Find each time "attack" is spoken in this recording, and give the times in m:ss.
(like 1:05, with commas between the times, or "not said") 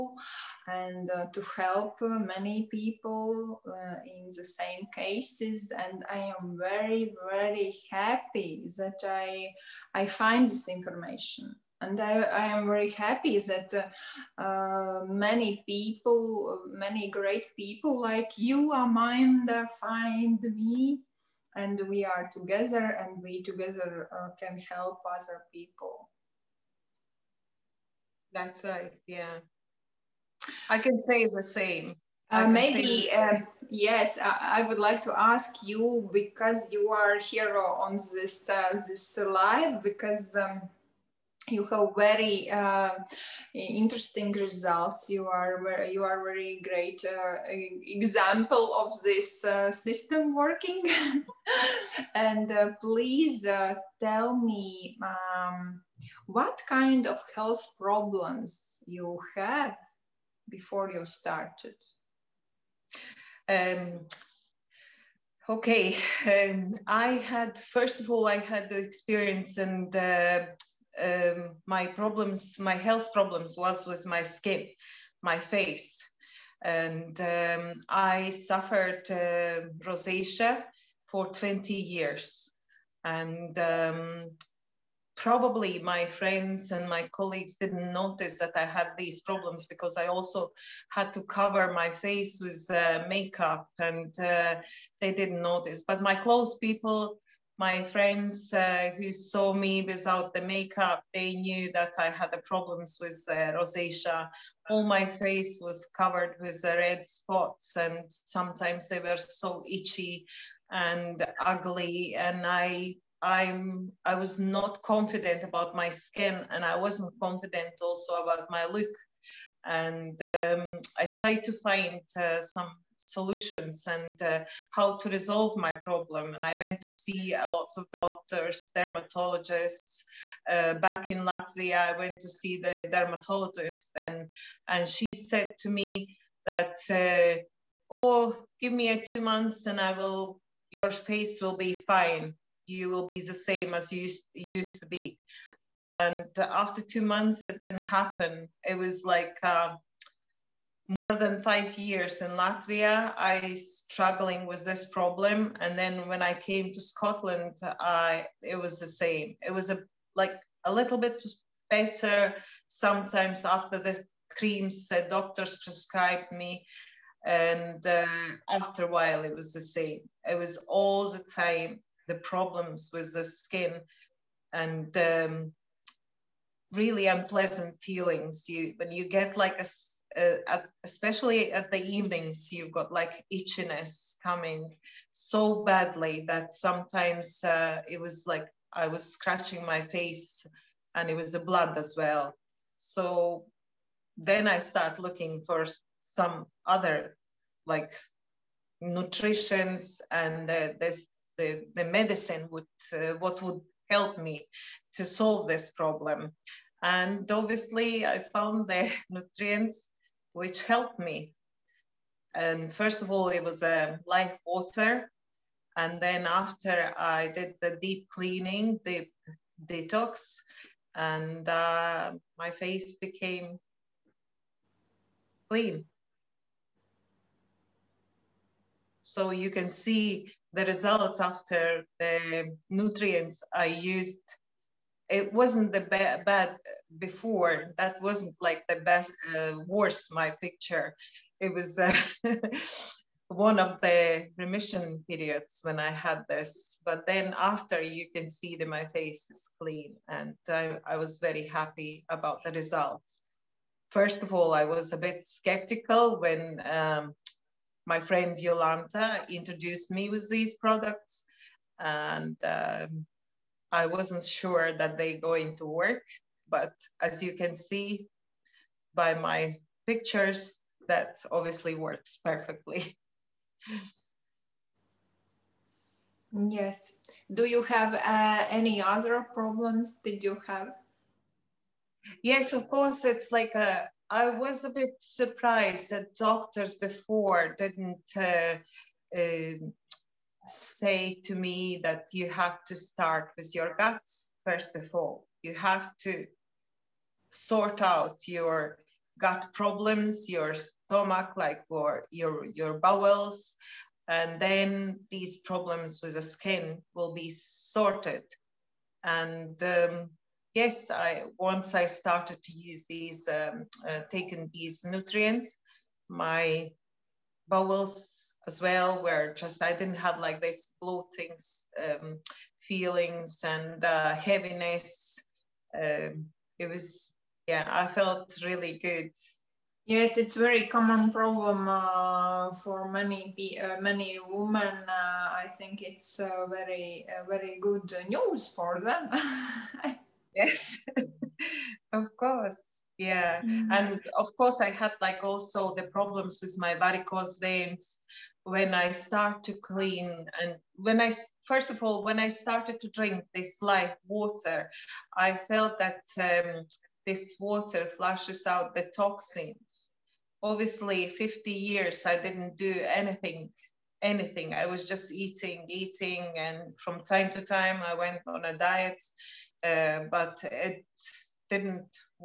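not said.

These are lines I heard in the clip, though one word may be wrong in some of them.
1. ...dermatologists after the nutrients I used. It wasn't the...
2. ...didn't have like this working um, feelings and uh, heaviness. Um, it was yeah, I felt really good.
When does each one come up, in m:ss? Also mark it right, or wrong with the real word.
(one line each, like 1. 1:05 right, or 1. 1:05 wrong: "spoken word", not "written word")
1. 3:50 wrong: "results", not "dermatologists"
2. 5:19 wrong: "bloating", not "working".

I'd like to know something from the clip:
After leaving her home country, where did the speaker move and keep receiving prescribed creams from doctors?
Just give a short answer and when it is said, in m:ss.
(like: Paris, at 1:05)
Scotland, at 2:36.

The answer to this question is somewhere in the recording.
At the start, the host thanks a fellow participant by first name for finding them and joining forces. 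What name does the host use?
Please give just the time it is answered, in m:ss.
0:18.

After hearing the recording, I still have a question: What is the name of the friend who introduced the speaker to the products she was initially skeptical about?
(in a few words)
Yolanta.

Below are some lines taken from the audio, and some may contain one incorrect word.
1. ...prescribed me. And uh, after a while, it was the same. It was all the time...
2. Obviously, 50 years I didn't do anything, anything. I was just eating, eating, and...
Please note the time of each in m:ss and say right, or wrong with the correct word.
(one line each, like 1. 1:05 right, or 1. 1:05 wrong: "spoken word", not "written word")
1. 2:45 right
2. 6:00 right.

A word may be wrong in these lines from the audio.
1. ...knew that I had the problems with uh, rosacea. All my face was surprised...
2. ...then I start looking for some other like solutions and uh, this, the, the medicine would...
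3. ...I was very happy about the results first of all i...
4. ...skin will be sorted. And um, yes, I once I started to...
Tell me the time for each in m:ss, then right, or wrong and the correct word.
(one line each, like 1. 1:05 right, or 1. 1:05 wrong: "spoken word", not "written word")
1. 1:41 wrong: "covered", not "surprised"
2. 3:14 wrong: "nutritions", not "solutions"
3. 4:10 right
4. 5:06 right.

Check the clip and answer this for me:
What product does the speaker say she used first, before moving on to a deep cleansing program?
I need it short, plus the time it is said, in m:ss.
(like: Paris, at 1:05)
Life water, at 3:34.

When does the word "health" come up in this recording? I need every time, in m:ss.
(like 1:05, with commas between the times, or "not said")
0:57, 1:12.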